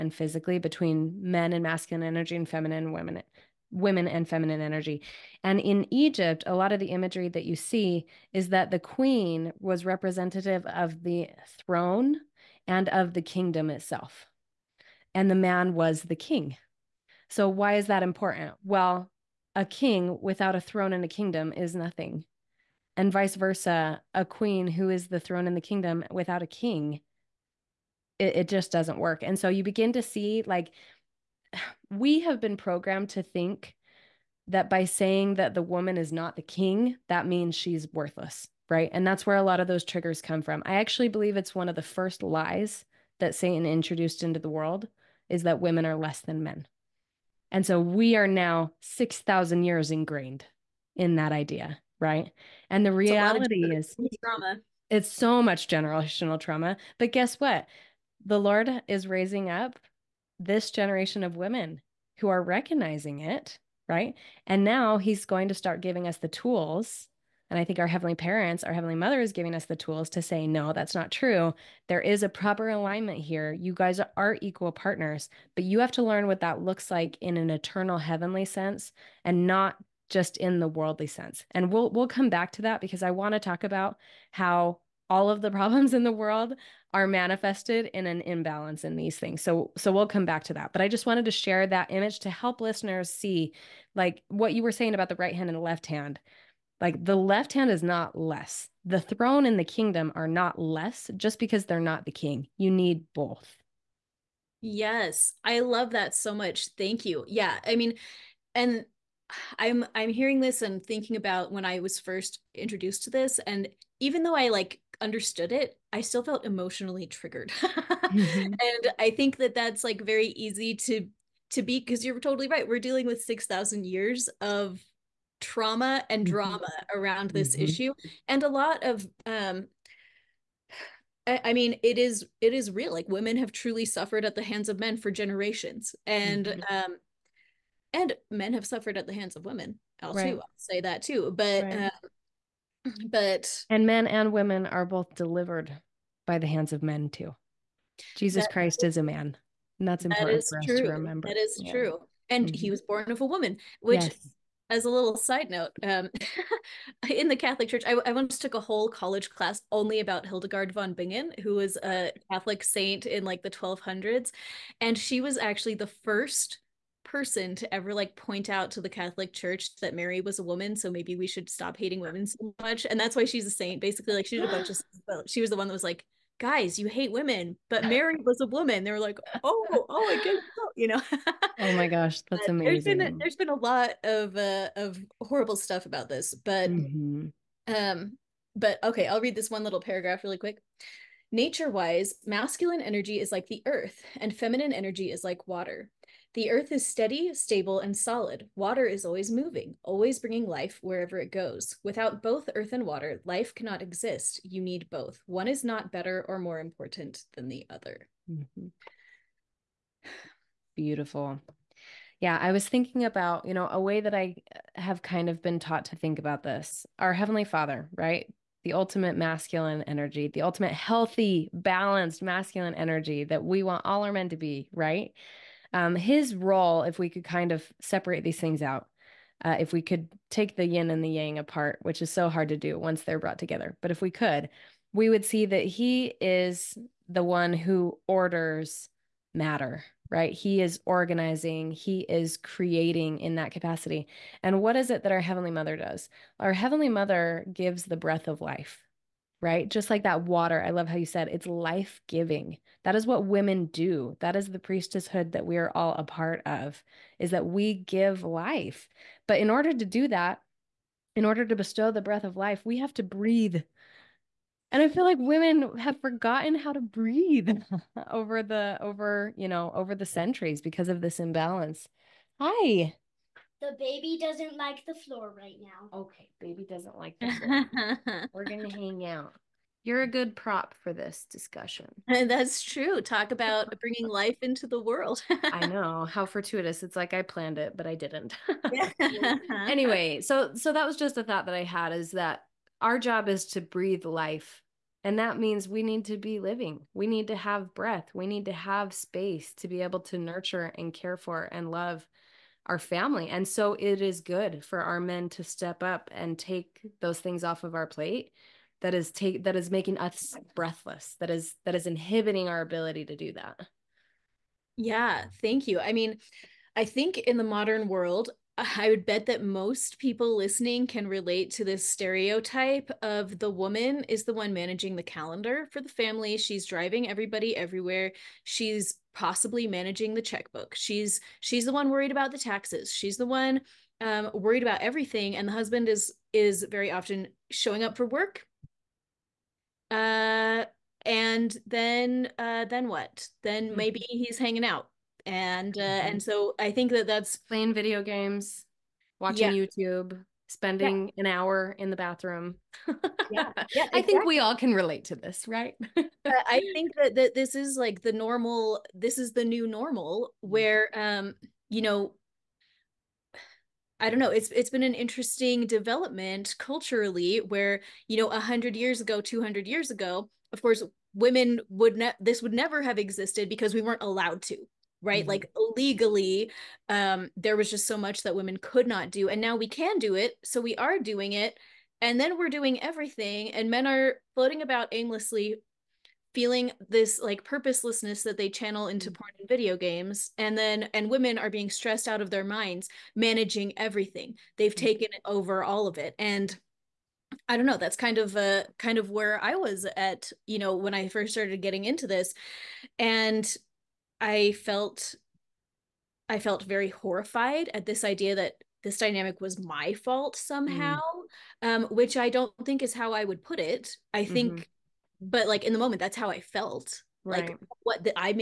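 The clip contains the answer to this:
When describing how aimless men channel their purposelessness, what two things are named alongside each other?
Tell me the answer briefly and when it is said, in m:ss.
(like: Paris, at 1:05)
porn and video games, at 6:29.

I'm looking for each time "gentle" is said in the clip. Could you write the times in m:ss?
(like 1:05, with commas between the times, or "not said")
not said.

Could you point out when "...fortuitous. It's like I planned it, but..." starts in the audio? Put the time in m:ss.
4:46.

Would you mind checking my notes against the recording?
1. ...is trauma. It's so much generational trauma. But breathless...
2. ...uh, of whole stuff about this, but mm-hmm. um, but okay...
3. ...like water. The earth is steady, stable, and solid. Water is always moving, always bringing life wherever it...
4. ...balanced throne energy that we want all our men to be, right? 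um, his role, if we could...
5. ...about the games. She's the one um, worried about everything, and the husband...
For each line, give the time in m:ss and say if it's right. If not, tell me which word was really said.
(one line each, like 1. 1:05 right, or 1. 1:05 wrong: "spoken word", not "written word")
1. 0:53 wrong: "guess", not "breathless"
2. 3:04 wrong: "horrible", not "whole"
3. 3:15 right
4. 3:41 wrong: "masculine", not "throne"
5. 5:32 wrong: "taxes", not "games".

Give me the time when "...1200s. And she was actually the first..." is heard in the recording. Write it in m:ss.
2:43.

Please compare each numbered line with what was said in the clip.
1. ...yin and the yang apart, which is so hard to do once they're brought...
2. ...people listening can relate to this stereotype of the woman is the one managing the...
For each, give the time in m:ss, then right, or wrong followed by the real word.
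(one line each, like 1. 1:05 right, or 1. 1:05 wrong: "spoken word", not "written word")
1. 3:50 right
2. 5:19 right.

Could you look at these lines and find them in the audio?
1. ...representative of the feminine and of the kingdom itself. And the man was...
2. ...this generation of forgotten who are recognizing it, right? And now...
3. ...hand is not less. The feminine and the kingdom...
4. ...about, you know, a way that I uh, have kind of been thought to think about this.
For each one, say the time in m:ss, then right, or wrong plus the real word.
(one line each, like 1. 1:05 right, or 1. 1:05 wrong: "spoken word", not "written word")
1. 0:09 wrong: "throne", not "feminine"
2. 1:00 wrong: "women", not "forgotten"
3. 1:37 wrong: "throne", not "feminine"
4. 3:33 wrong: "taught", not "thought".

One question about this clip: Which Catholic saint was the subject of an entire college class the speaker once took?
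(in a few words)
Hildegard von Bingen.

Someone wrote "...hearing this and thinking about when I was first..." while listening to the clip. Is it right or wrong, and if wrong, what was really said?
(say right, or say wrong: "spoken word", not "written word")
right.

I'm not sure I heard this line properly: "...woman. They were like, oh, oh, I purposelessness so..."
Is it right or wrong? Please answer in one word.
wrong.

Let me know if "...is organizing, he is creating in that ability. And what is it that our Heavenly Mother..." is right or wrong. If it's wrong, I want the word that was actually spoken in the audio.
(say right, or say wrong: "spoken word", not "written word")
wrong: "capacity", not "ability".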